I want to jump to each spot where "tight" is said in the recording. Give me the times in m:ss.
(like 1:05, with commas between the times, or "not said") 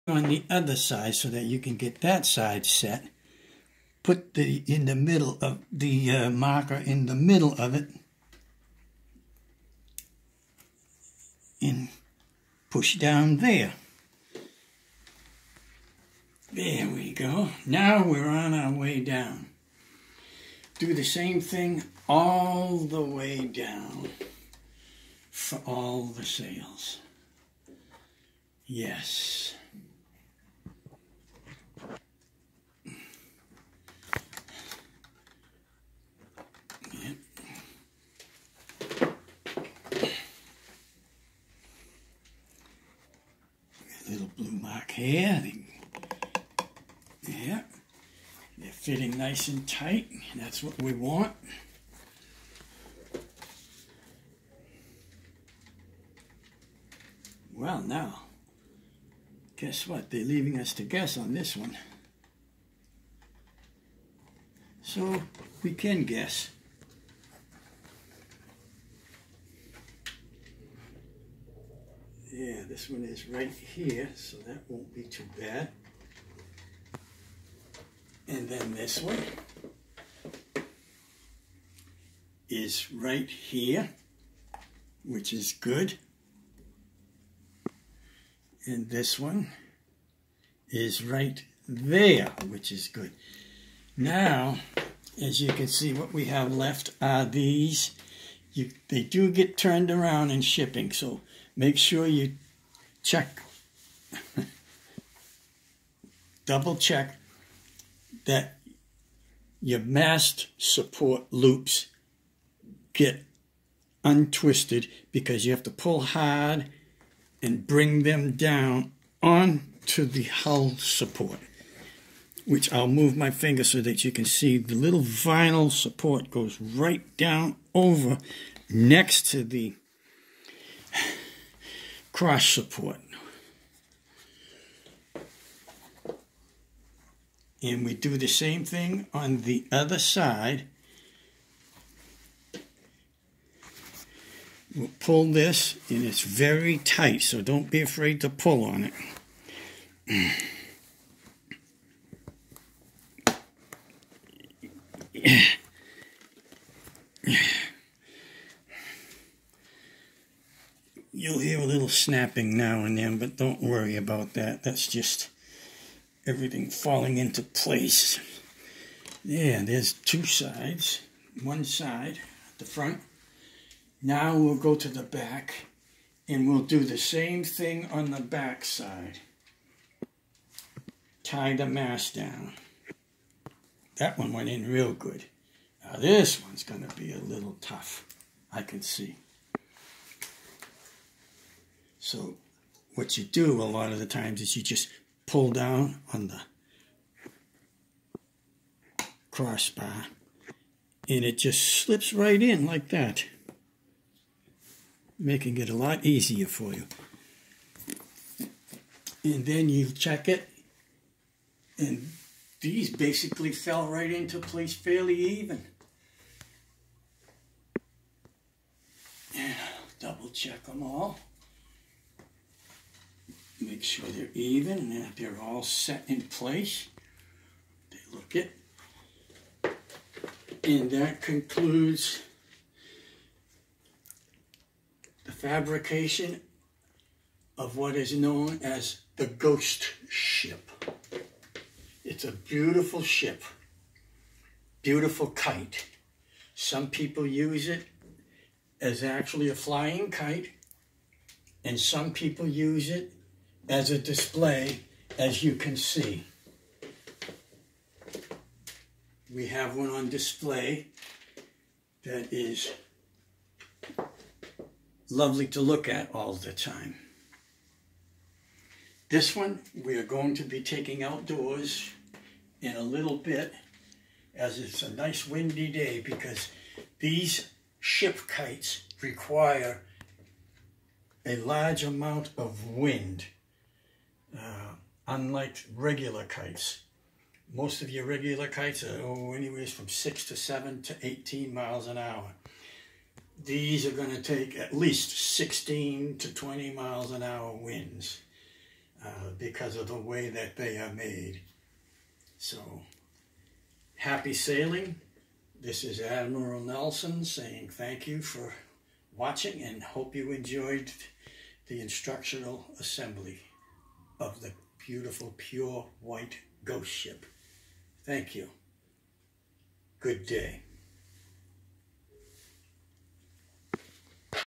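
0:49, 2:26.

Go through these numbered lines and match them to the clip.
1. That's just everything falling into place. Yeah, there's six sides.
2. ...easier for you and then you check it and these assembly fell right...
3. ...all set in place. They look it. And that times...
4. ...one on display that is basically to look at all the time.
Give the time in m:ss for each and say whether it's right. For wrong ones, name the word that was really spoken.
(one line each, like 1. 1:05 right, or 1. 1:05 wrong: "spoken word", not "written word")
1. 2:44 wrong: "two", not "six"
2. 3:26 wrong: "basically", not "assembly"
3. 3:45 wrong: "concludes", not "times"
4. 4:19 wrong: "lovely", not "basically".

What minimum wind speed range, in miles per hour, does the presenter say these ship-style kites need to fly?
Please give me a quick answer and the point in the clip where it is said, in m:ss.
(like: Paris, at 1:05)
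16 to 20, at 4:55.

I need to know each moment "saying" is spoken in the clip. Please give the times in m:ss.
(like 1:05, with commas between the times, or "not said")
5:07.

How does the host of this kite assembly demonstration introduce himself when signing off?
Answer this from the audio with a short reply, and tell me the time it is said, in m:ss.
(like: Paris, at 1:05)
Admiral Nelson, at 5:05.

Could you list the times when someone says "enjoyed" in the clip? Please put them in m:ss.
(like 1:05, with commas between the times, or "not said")
5:10.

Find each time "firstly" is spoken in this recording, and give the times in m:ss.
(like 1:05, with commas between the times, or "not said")
not said.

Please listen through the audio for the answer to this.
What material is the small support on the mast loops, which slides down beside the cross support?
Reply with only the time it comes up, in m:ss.
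2:05.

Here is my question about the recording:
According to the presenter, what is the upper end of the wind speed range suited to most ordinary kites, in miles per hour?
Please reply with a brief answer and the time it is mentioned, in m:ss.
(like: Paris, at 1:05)
18, at 4:51.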